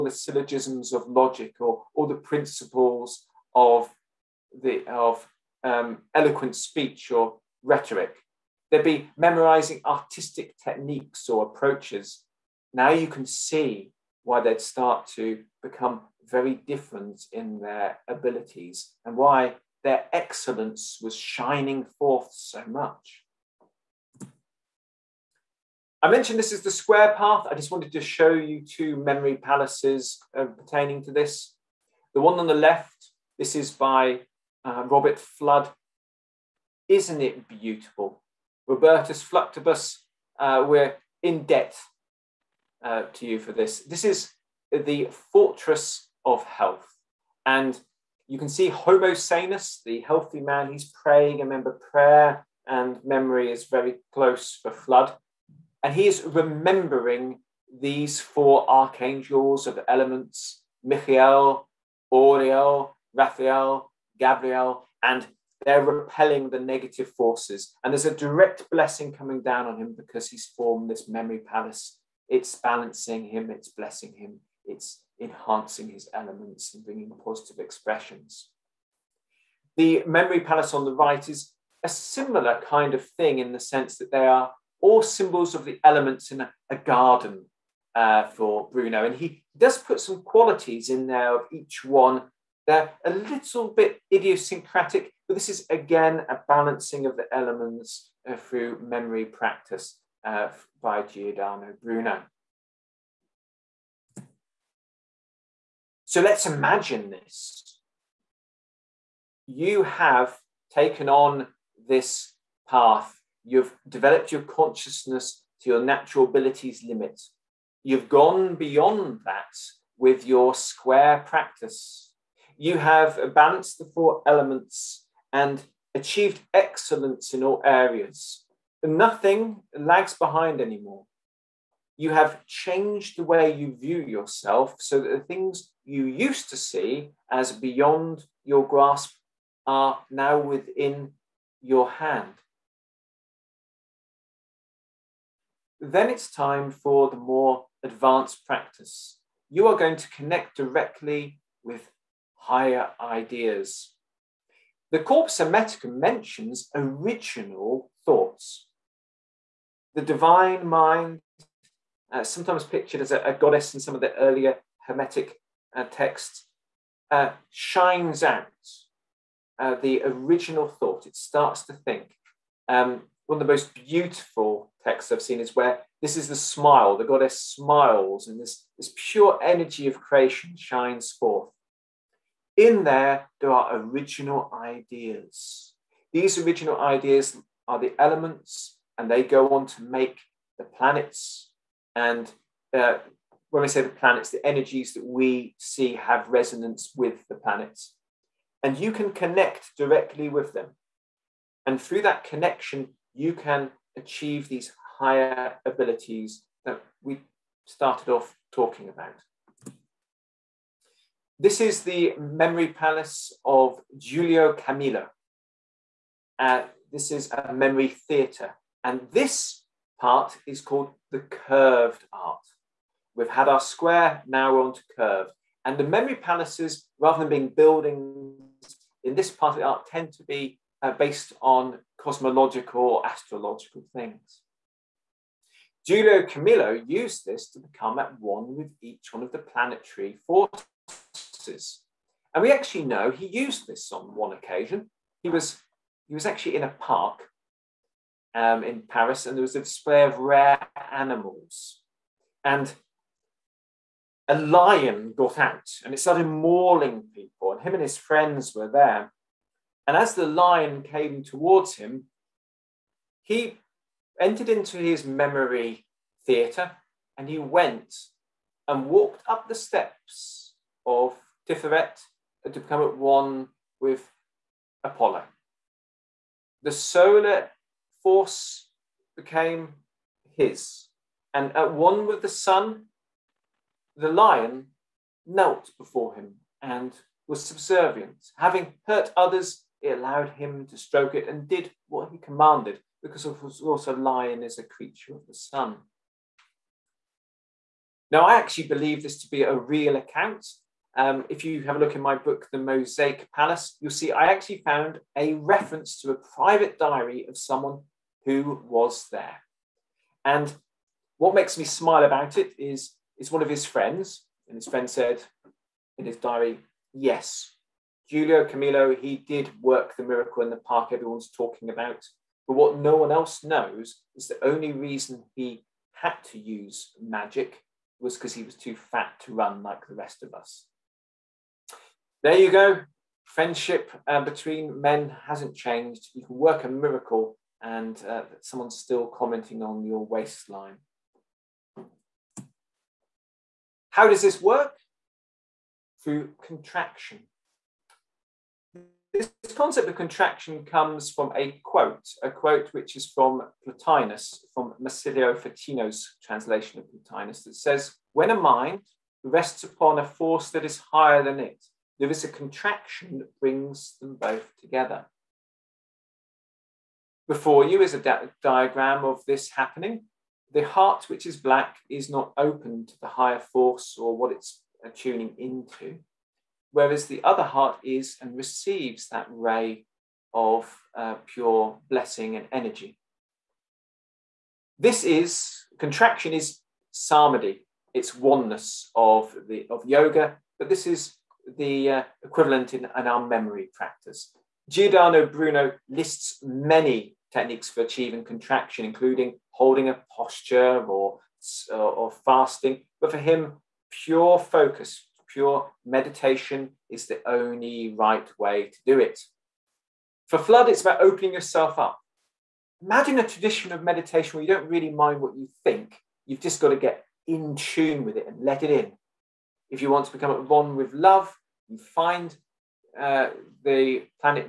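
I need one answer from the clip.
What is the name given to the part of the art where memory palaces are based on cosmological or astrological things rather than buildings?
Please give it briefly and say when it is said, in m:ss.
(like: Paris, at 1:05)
Curved art, at 3:41.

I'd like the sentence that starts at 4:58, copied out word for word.
Now, I actually believe this to be a real account.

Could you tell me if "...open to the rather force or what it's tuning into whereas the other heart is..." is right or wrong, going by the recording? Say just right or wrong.
wrong.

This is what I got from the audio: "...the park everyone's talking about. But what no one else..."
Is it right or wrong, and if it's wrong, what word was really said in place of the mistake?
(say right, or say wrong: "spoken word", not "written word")
right.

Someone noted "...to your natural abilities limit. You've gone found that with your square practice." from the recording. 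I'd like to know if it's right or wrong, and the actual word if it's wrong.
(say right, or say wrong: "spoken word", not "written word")
wrong: "beyond", not "found".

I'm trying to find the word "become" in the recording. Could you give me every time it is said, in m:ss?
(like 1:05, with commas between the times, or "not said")
0:15, 3:57, 4:32, 7:00.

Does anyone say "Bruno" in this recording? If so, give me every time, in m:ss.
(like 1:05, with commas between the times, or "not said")
1:28, 1:41, 6:35.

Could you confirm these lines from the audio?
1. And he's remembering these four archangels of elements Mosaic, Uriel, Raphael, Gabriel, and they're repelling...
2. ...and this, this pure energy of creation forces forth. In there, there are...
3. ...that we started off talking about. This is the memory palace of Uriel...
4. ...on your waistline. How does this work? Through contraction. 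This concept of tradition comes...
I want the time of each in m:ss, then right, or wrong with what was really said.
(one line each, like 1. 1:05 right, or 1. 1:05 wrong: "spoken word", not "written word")
1. 0:55 wrong: "Michael", not "Mosaic"
2. 2:58 wrong: "shines", not "forces"
3. 3:26 wrong: "Giulio", not "Uriel"
4. 5:39 wrong: "contraction", not "tradition".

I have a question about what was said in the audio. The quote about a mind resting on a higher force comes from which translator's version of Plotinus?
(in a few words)
Marsilio Ficino.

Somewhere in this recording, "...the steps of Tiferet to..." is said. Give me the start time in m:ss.
4:29.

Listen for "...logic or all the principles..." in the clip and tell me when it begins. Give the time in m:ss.
0:01.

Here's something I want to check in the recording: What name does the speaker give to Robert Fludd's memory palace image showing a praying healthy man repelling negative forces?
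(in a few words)
Fortress of health.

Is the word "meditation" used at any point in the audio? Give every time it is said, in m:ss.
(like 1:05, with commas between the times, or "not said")
6:45, 6:53.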